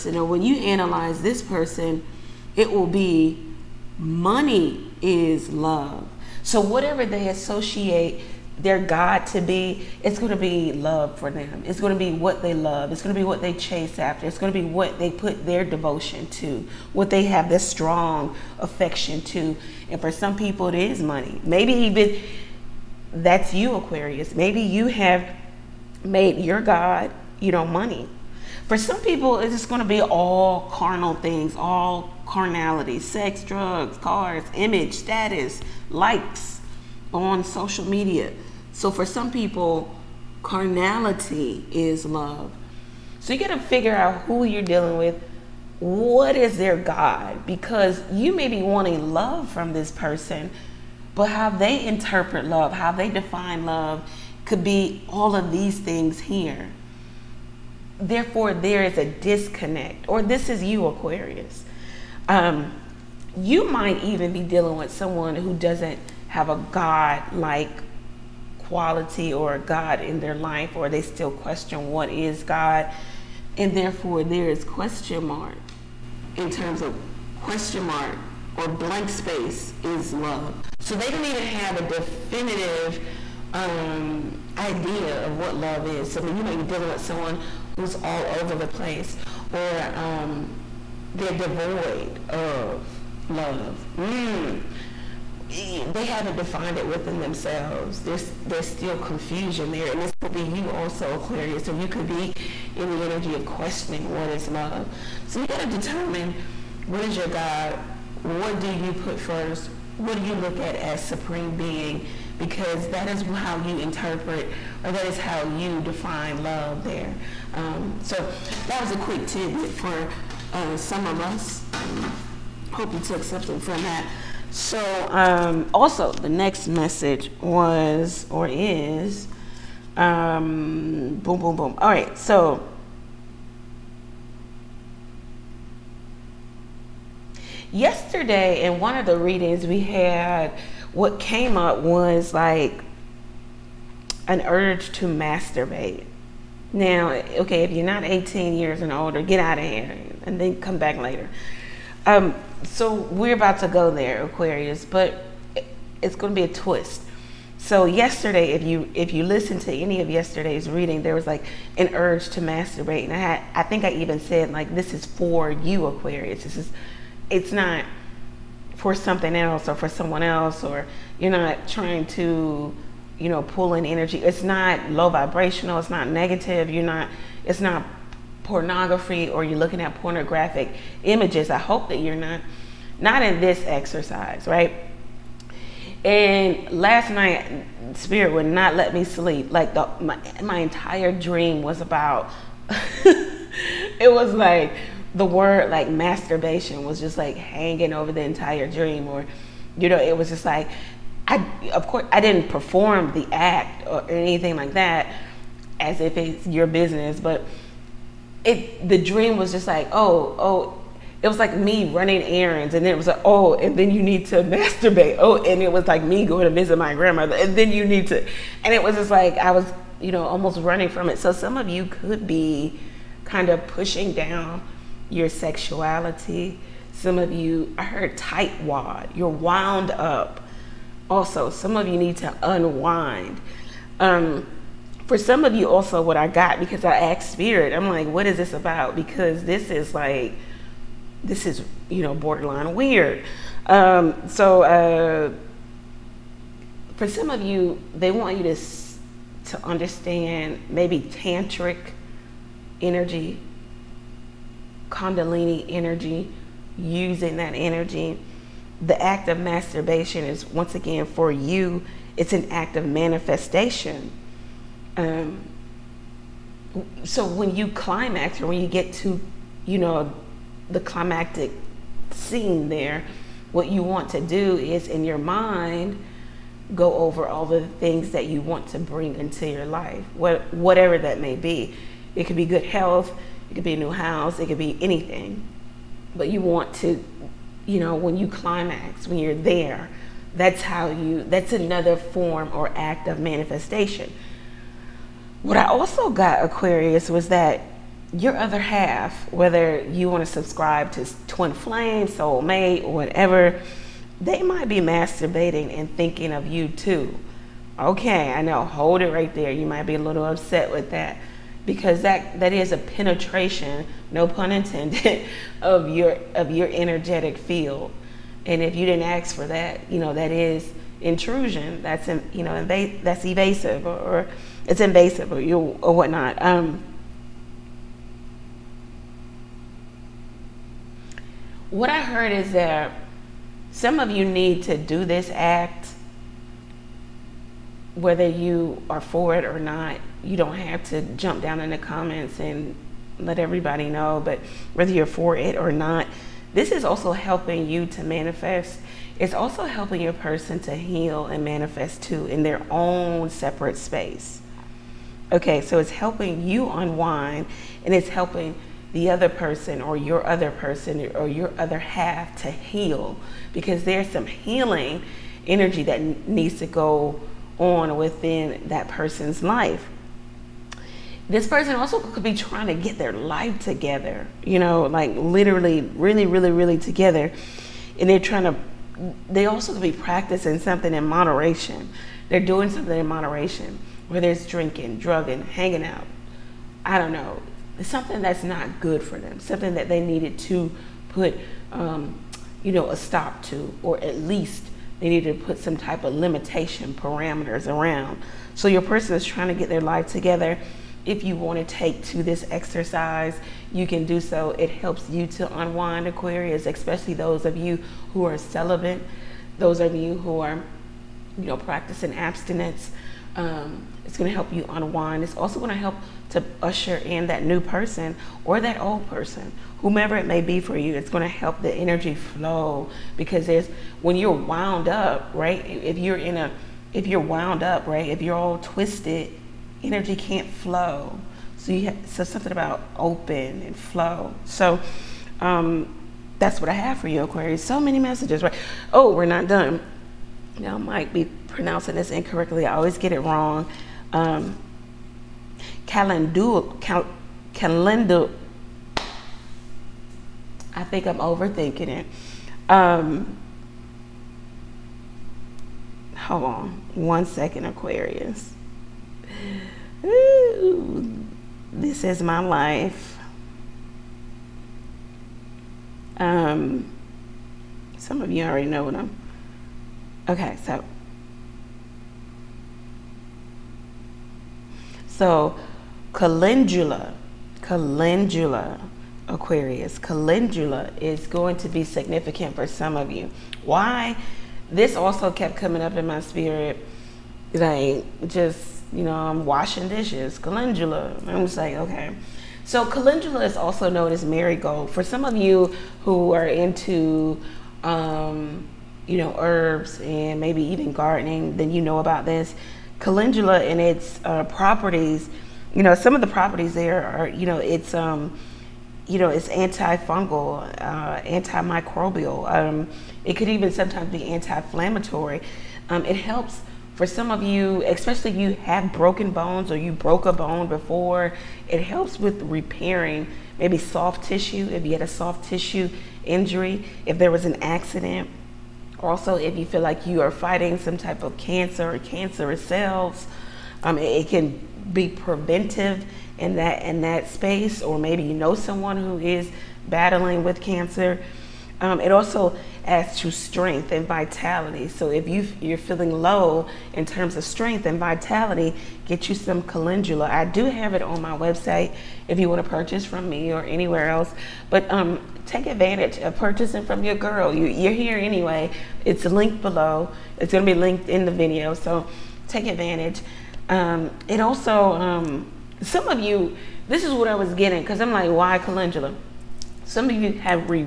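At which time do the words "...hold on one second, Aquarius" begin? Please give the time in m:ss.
7:36.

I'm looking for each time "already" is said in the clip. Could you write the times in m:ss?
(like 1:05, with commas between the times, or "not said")
7:48.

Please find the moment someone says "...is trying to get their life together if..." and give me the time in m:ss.
6:39.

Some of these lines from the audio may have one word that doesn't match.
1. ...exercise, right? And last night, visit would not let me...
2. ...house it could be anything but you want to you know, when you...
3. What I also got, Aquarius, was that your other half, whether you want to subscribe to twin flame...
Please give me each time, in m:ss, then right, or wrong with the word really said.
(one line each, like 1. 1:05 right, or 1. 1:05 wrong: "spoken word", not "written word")
1. 3:03 wrong: "spirit", not "visit"
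2. 4:43 right
3. 4:55 right.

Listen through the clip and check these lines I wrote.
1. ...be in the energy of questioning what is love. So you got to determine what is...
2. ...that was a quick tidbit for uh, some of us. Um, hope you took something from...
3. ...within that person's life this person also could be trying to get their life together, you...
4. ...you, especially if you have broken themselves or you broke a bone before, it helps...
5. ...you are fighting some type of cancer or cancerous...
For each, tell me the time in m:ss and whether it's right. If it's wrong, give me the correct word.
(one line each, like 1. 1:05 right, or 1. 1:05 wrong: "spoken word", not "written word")
1. 1:42 right
2. 1:58 right
3. 6:07 right
4. 8:37 wrong: "bones", not "themselves"
5. 8:50 right.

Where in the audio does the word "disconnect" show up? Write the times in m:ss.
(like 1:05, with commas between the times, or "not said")
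0:59.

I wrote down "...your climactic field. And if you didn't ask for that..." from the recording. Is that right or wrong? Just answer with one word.
wrong.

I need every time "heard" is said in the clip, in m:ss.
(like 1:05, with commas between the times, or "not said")
3:47, 5:32.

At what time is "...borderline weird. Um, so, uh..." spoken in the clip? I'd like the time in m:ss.
4:02.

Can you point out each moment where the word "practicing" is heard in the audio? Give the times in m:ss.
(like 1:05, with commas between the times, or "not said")
6:19, 6:51.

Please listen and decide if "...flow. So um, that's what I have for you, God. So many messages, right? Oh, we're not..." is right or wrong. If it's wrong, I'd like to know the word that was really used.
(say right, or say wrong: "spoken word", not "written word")
wrong: "Aquarius", not "God".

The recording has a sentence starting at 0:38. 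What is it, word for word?
So for some people, carnality is love.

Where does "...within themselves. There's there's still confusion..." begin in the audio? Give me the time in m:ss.
1:36.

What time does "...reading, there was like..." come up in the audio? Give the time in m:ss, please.
2:40.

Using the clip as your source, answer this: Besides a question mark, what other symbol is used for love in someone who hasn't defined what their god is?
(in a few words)
blank space.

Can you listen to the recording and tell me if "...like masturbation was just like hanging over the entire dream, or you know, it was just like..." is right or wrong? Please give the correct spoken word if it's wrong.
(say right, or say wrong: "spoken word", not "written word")
right.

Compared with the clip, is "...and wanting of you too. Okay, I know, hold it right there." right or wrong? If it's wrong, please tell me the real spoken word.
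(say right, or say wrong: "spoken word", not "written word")
wrong: "thinking", not "wanting".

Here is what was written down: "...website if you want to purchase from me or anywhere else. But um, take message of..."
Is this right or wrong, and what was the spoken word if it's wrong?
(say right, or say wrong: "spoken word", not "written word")
wrong: "advantage", not "message".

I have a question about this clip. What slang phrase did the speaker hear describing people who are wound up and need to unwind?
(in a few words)
tight wad.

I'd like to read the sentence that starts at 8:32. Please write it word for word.
Um, it could even sometimes be anti-inflammatory.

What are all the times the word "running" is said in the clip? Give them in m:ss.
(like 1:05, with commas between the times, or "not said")
3:31, 3:40.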